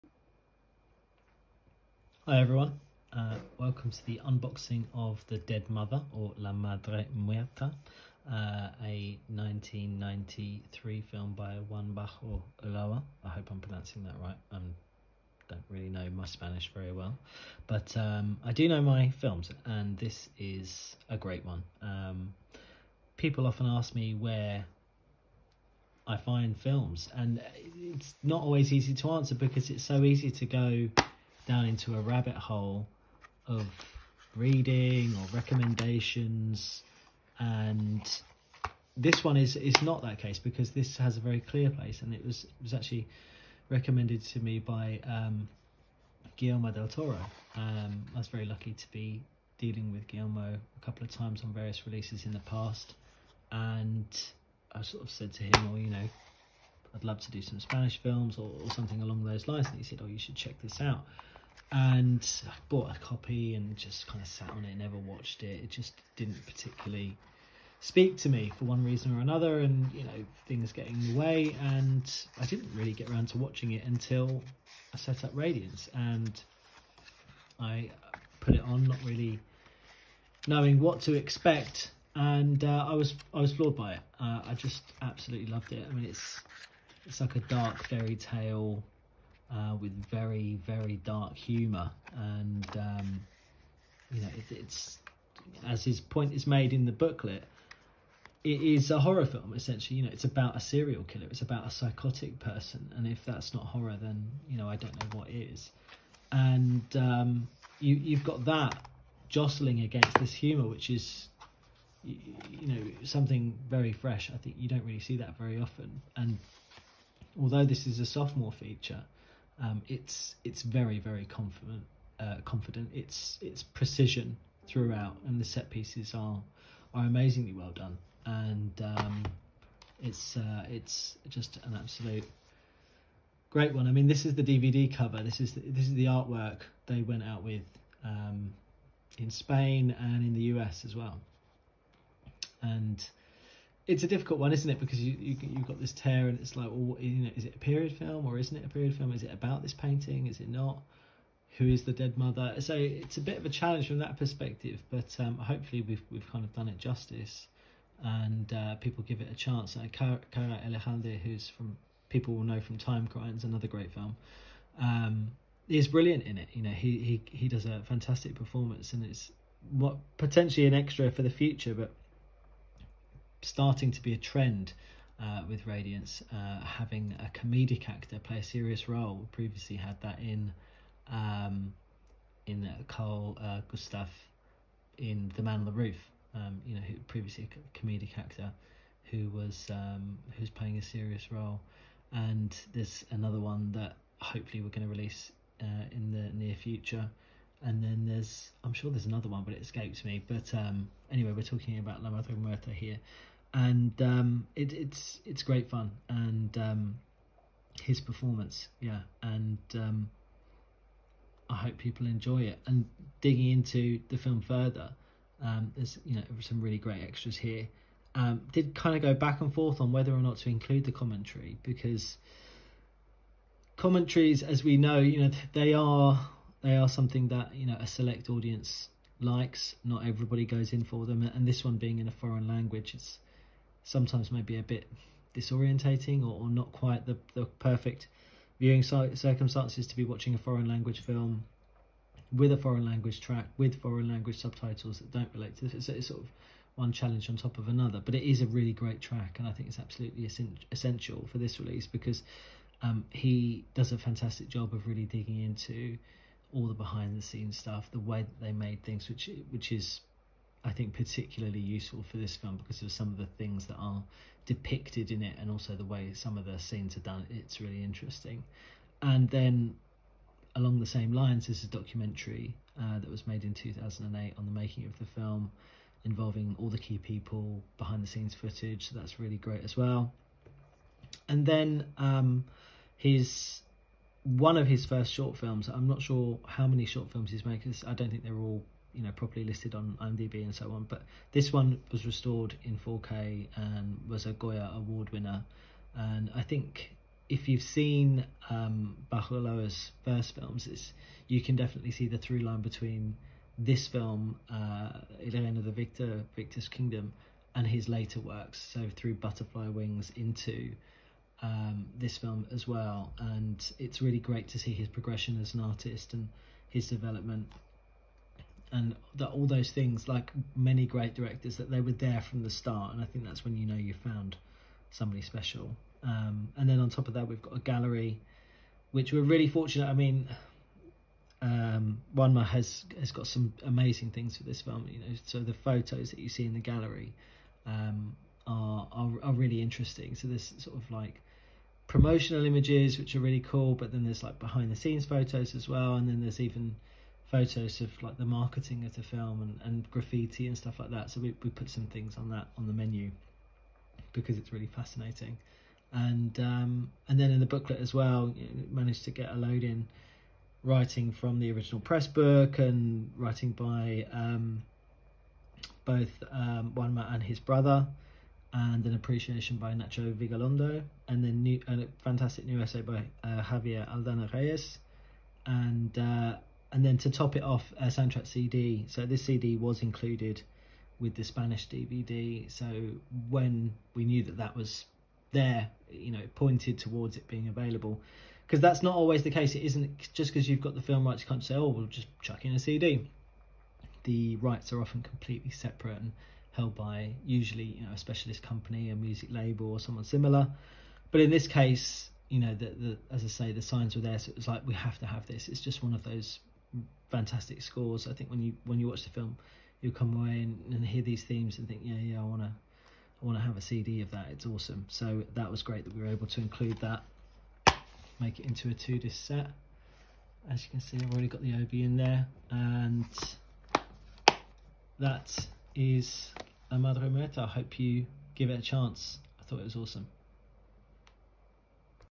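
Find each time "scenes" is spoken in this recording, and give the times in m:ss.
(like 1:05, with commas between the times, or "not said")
4:17, 4:26, 4:38, 5:44.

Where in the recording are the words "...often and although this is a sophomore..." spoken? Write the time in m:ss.
1:55.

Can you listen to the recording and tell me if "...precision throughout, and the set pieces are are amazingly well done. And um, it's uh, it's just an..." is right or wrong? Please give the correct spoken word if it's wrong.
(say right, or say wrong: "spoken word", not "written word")
right.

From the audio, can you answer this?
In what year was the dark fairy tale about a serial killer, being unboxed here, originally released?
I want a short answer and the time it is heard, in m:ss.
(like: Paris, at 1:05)
1993, at 0:09.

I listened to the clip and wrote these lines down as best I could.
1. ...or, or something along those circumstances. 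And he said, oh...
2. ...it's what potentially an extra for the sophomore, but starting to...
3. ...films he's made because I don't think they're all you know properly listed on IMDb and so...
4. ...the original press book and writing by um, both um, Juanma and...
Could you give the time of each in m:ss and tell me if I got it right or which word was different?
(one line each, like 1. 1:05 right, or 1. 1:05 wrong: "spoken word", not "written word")
1. 0:58 wrong: "lines", not "circumstances"
2. 2:49 wrong: "future", not "sophomore"
3. 4:47 right
4. 6:01 right.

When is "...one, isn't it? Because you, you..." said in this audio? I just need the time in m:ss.
2:24.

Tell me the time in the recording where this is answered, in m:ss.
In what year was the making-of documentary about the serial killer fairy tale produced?
4:33.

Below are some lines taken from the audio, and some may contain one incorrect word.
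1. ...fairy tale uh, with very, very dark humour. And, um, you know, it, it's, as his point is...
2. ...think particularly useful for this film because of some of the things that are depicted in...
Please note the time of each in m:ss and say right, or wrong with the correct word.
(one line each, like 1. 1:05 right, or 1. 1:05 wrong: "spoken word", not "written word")
1. 1:27 right
2. 4:20 right.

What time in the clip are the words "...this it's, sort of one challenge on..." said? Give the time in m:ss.
4:05.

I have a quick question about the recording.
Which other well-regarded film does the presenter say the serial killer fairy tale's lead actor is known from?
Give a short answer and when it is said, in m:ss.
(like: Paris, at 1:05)
Time Crimes, at 2:42.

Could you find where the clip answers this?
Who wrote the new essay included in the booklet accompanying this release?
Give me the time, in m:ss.
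6:13.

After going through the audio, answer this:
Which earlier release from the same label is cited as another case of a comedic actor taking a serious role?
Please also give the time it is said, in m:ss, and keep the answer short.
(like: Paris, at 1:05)
The Man on the Roof, at 3:05.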